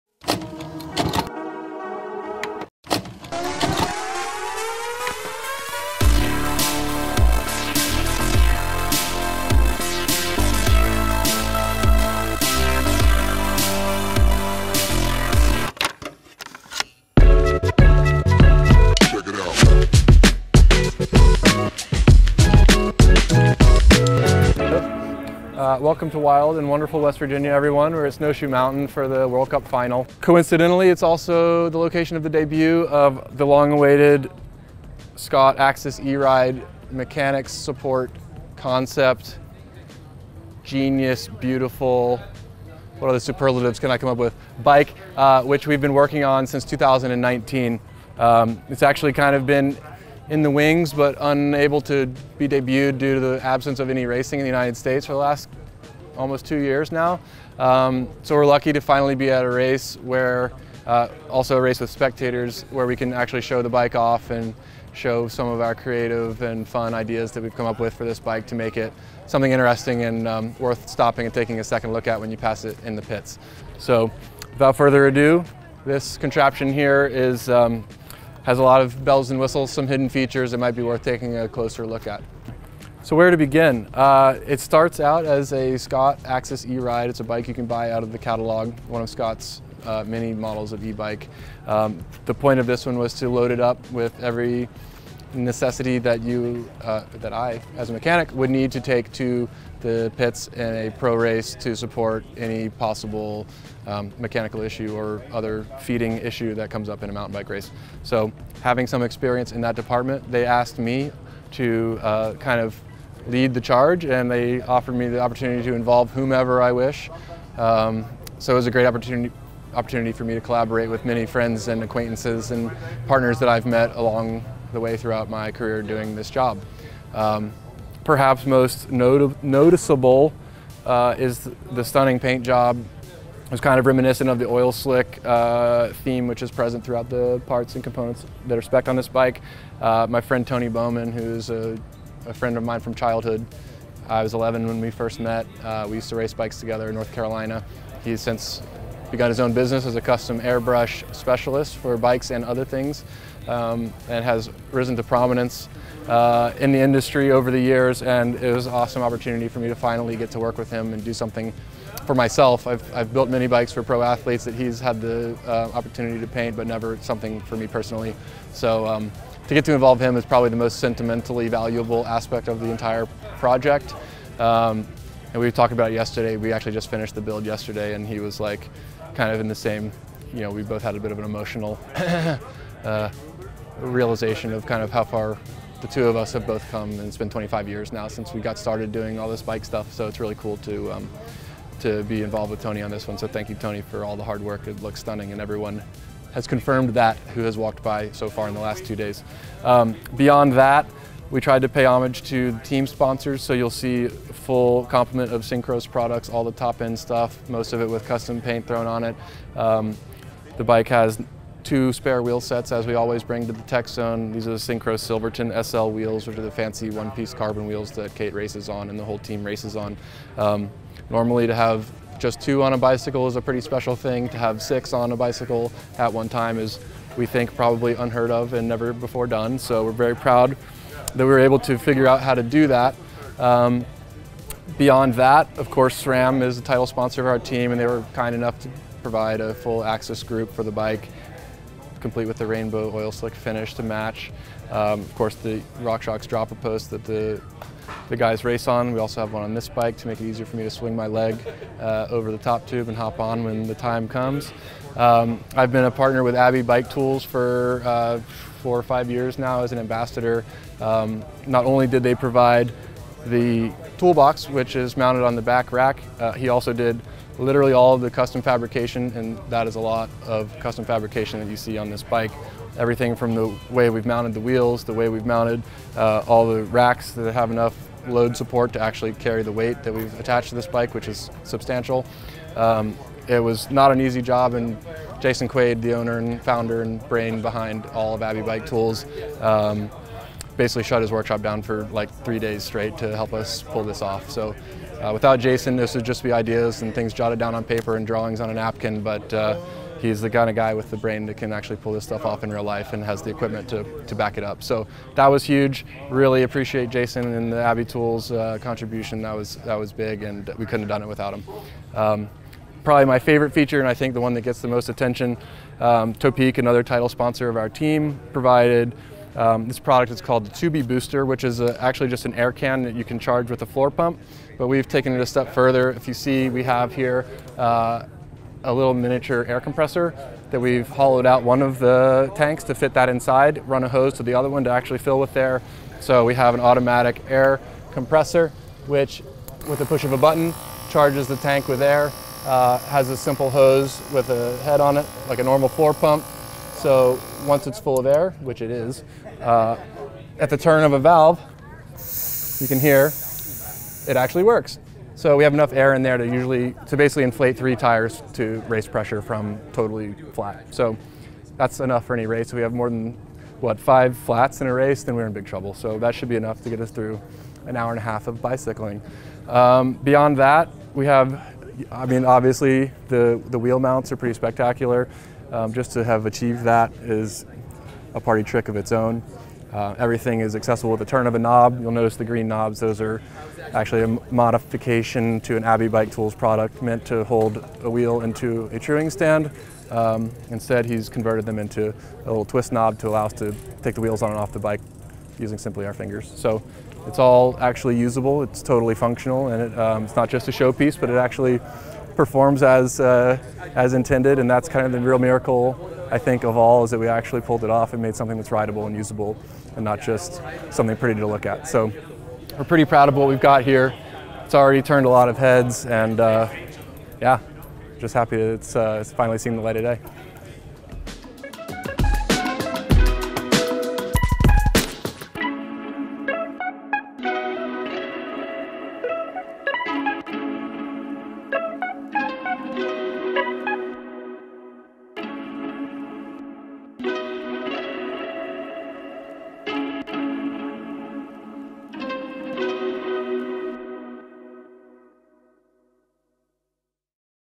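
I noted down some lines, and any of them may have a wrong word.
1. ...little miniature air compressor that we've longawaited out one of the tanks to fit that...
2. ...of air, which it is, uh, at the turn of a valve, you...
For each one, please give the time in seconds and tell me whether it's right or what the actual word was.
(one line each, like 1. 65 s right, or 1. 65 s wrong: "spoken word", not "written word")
1. 328 s wrong: "hollowed", not "longawaited"
2. 347 s right.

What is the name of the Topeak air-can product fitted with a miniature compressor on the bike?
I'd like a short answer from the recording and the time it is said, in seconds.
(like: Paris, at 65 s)
TubiBooster, at 320 s.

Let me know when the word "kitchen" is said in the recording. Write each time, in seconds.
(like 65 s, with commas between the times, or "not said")
not said.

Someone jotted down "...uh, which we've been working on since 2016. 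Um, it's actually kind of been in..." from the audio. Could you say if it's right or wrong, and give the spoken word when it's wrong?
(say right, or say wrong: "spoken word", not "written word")
wrong: "2019", not "2016".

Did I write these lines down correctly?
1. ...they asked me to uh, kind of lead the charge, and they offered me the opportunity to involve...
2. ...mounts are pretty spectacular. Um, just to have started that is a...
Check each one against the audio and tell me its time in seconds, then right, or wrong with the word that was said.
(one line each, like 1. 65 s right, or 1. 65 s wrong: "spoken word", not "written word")
1. 110 s right
2. 373 s wrong: "achieved", not "started".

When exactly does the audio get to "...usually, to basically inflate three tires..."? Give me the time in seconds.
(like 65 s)
356 s.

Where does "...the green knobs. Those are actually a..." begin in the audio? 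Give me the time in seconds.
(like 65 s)
382 s.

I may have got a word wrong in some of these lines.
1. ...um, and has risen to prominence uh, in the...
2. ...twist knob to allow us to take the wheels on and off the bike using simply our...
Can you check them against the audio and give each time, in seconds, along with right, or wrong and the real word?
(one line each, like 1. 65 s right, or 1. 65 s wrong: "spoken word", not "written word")
1. 153 s right
2. 392 s right.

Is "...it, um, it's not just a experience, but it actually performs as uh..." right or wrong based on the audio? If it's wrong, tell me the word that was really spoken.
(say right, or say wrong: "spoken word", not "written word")
wrong: "showpiece", not "experience".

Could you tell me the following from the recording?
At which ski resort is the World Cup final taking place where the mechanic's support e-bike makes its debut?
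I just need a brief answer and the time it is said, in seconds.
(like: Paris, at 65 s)
Snowshoe Mountain, at 28 s.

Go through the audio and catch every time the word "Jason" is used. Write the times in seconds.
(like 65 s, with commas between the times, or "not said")
285 s, 295 s, 306 s.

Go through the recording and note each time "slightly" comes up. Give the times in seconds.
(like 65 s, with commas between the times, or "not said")
not said.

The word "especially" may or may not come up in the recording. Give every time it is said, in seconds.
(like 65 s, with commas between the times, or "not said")
not said.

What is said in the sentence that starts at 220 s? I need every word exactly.
Um, normally to have just two on a bicycle is a pretty special thing.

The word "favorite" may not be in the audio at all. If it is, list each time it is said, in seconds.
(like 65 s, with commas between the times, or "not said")
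313 s.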